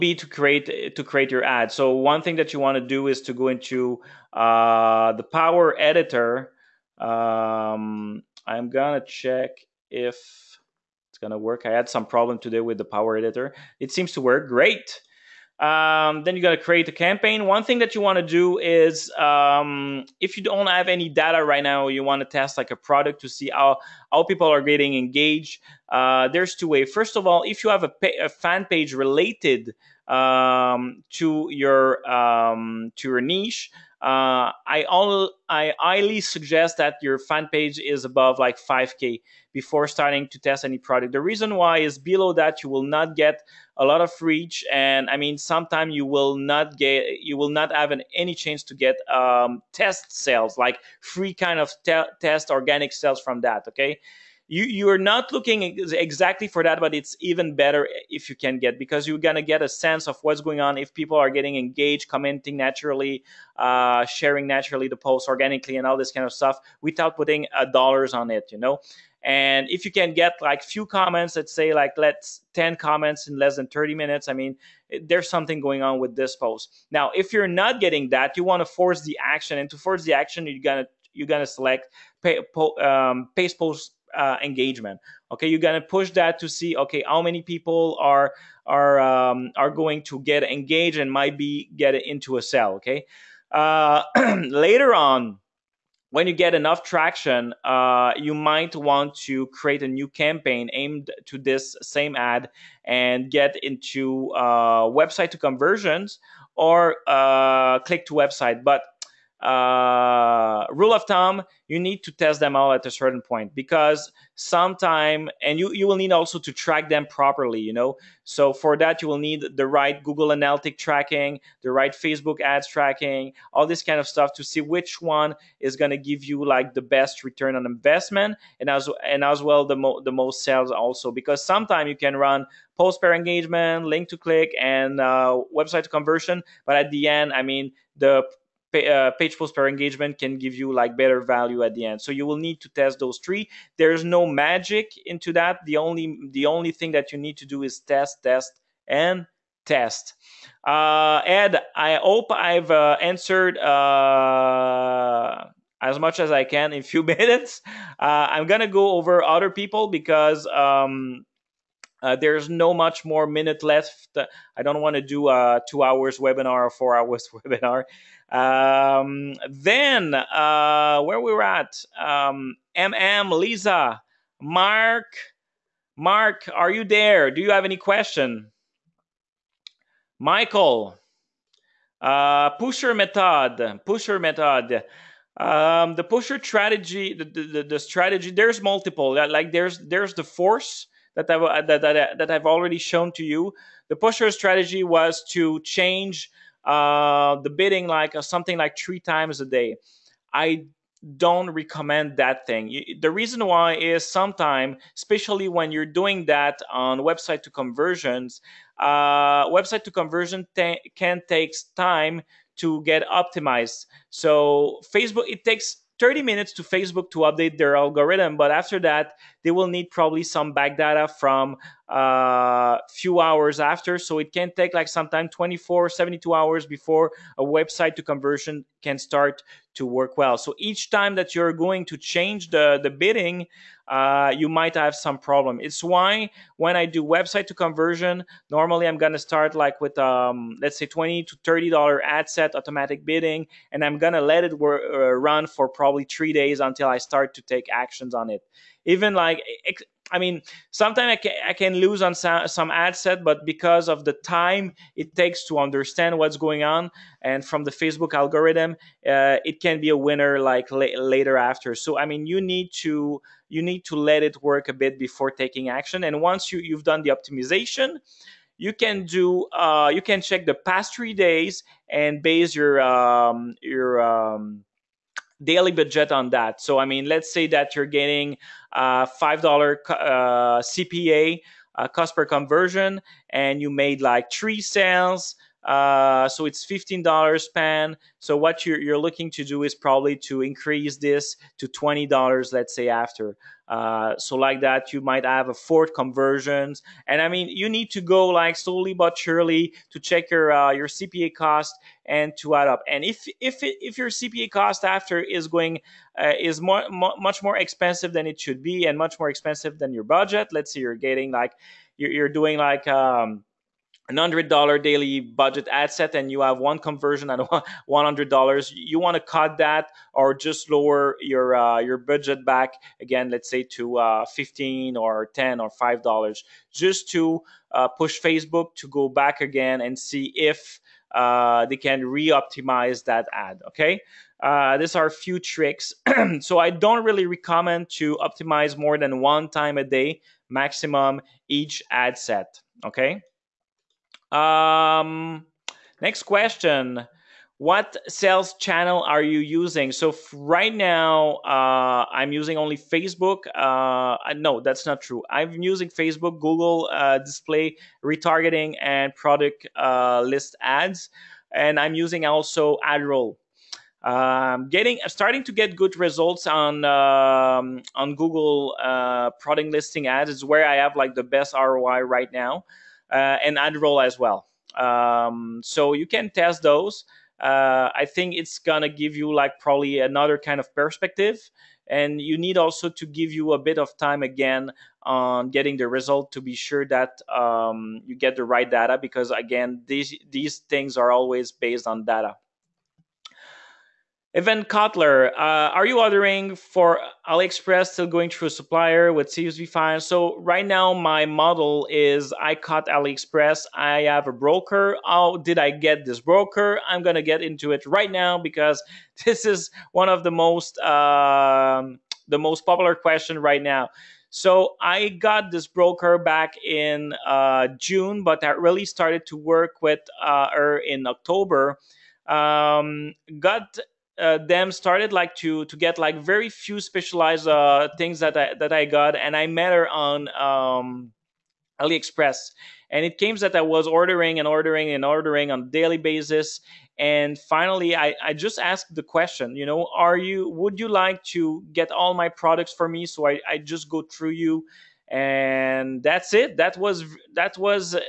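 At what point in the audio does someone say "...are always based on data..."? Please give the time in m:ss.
6:30.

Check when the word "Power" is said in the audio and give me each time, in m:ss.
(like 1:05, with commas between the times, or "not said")
0:05, 0:12.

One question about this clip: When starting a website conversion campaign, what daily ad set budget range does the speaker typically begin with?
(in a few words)
$20 to $30.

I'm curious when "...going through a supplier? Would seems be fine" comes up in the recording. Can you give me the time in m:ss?
6:38.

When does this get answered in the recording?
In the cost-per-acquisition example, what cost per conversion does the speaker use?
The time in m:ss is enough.
4:39.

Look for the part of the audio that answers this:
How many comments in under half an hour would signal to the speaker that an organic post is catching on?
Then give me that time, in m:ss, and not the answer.
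1:12.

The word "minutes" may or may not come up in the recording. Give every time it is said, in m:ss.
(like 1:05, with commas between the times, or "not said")
1:13, 2:37, 2:43, 3:36.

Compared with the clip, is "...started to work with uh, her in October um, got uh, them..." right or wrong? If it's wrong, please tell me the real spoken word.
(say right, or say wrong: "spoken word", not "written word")
right.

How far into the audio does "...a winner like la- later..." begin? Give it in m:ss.
4:19.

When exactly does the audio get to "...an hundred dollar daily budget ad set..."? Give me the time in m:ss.
5:14.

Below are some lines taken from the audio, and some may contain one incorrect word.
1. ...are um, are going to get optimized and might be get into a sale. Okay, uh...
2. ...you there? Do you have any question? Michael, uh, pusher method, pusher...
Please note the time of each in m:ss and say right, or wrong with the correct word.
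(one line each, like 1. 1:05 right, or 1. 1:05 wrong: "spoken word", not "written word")
1. 1:28 wrong: "engaged", not "optimized"
2. 2:56 right.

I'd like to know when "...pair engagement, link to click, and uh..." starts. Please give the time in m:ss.
2:13.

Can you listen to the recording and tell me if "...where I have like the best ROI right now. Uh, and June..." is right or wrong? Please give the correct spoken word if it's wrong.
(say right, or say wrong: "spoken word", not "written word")
wrong: "Adroll", not "June".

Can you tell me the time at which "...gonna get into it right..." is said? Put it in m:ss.
6:47.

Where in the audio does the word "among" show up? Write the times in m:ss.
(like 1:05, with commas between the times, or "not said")
not said.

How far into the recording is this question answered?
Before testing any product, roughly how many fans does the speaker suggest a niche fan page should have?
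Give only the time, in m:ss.
0:38.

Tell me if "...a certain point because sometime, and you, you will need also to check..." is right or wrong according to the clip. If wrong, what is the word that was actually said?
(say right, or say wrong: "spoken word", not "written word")
wrong: "track", not "check".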